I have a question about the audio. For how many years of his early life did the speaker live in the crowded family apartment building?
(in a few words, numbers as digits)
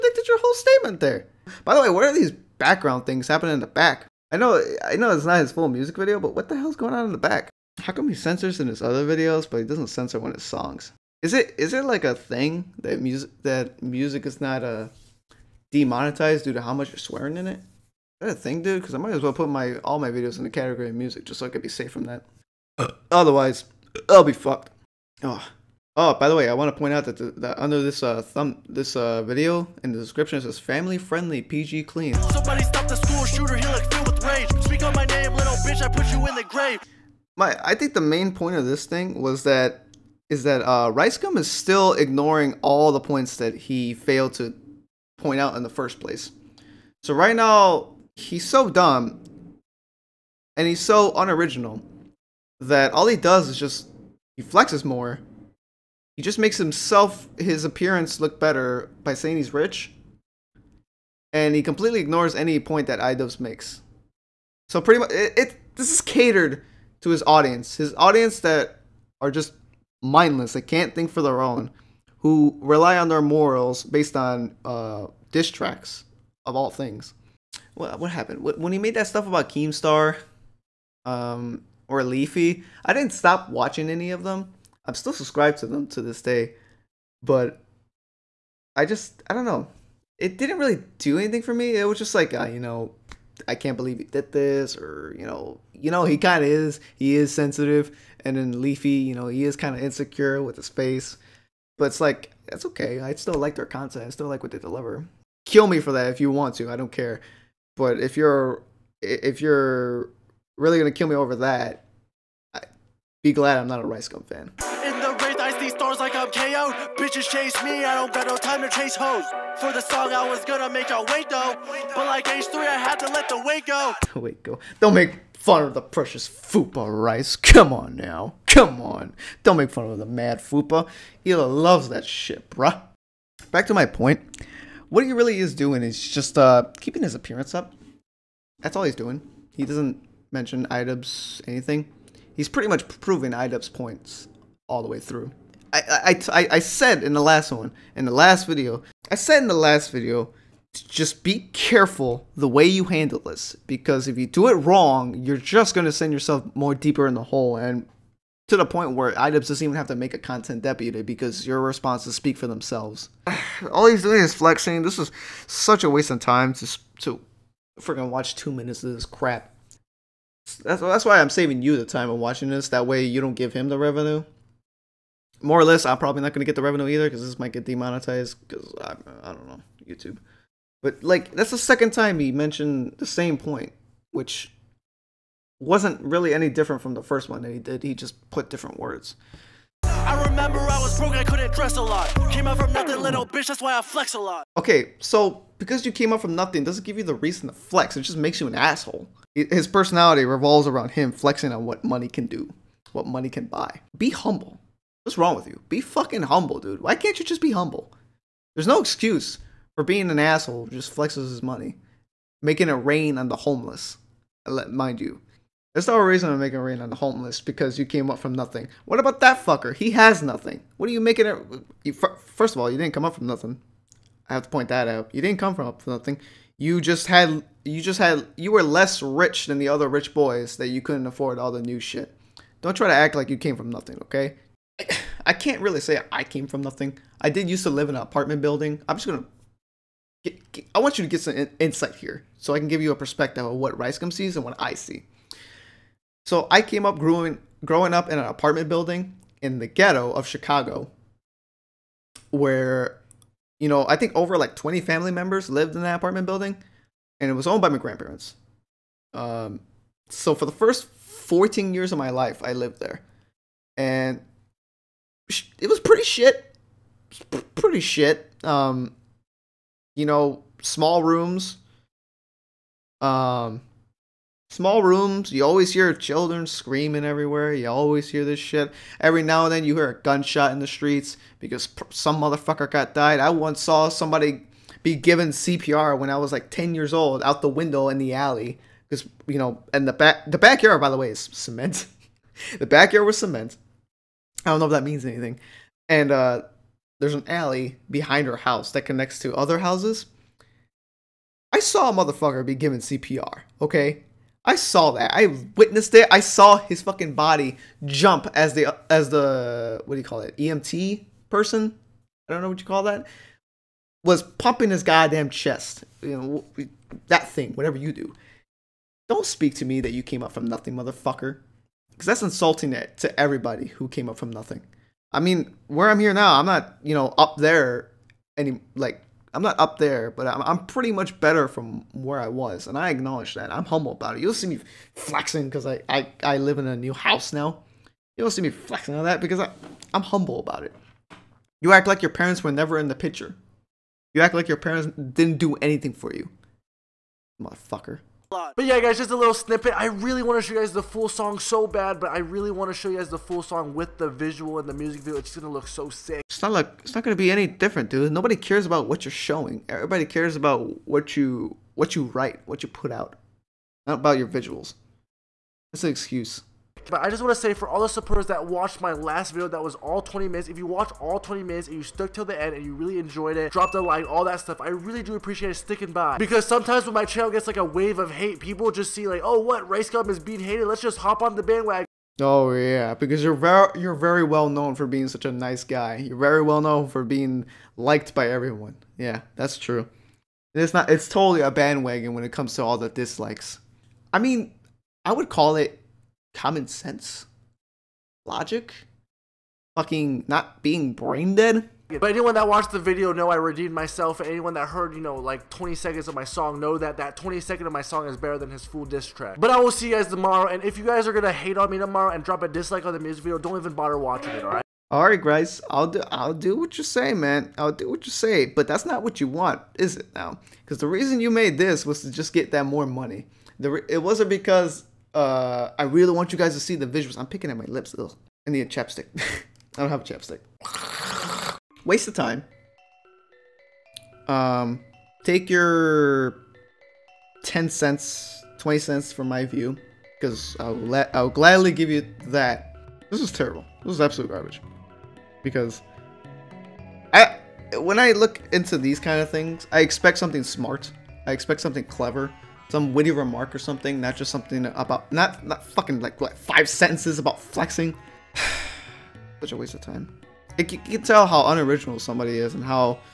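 14.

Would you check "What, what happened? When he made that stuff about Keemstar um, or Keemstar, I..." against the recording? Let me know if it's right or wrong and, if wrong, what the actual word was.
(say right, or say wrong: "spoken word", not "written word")
wrong: "Leafy", not "Keemstar".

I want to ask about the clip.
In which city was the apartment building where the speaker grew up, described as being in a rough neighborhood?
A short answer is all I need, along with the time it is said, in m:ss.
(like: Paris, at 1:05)
Chicago, at 4:10.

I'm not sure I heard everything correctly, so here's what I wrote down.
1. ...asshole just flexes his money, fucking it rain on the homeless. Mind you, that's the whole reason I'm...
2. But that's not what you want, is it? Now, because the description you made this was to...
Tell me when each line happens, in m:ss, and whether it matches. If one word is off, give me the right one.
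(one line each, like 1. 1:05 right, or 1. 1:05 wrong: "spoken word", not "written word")
1. 3:30 wrong: "making", not "fucking"
2. 6:58 wrong: "reason", not "description".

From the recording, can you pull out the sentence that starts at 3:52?
Don't try to act like you came from nothing, okay?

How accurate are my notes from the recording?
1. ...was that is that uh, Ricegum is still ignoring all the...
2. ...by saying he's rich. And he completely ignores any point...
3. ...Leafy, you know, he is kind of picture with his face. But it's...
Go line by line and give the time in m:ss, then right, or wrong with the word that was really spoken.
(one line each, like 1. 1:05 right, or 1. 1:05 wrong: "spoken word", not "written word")
1. 0:39 right
2. 0:59 right
3. 1:38 wrong: "insecure", not "picture".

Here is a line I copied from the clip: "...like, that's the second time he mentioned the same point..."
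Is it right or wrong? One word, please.
right.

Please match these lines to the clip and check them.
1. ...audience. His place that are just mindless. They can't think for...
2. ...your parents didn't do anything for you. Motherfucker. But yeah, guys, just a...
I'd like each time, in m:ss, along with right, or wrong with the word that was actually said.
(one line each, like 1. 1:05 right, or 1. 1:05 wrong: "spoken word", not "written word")
1. 1:07 wrong: "audience", not "place"
2. 5:44 right.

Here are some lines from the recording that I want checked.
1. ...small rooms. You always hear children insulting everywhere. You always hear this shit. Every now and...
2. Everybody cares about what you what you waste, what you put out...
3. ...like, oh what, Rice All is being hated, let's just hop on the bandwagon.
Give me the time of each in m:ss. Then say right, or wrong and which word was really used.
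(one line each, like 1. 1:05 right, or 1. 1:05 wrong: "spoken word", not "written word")
1. 4:34 wrong: "screaming", not "insulting"
2. 5:59 wrong: "write", not "waste"
3. 6:19 wrong: "Gum", not "All".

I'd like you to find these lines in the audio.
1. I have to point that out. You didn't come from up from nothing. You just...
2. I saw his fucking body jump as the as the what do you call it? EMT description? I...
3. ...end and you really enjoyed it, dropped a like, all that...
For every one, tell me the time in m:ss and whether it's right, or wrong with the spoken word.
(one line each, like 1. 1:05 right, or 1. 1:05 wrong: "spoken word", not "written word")
1. 3:44 right
2. 5:06 wrong: "person", not "description"
3. 6:12 right.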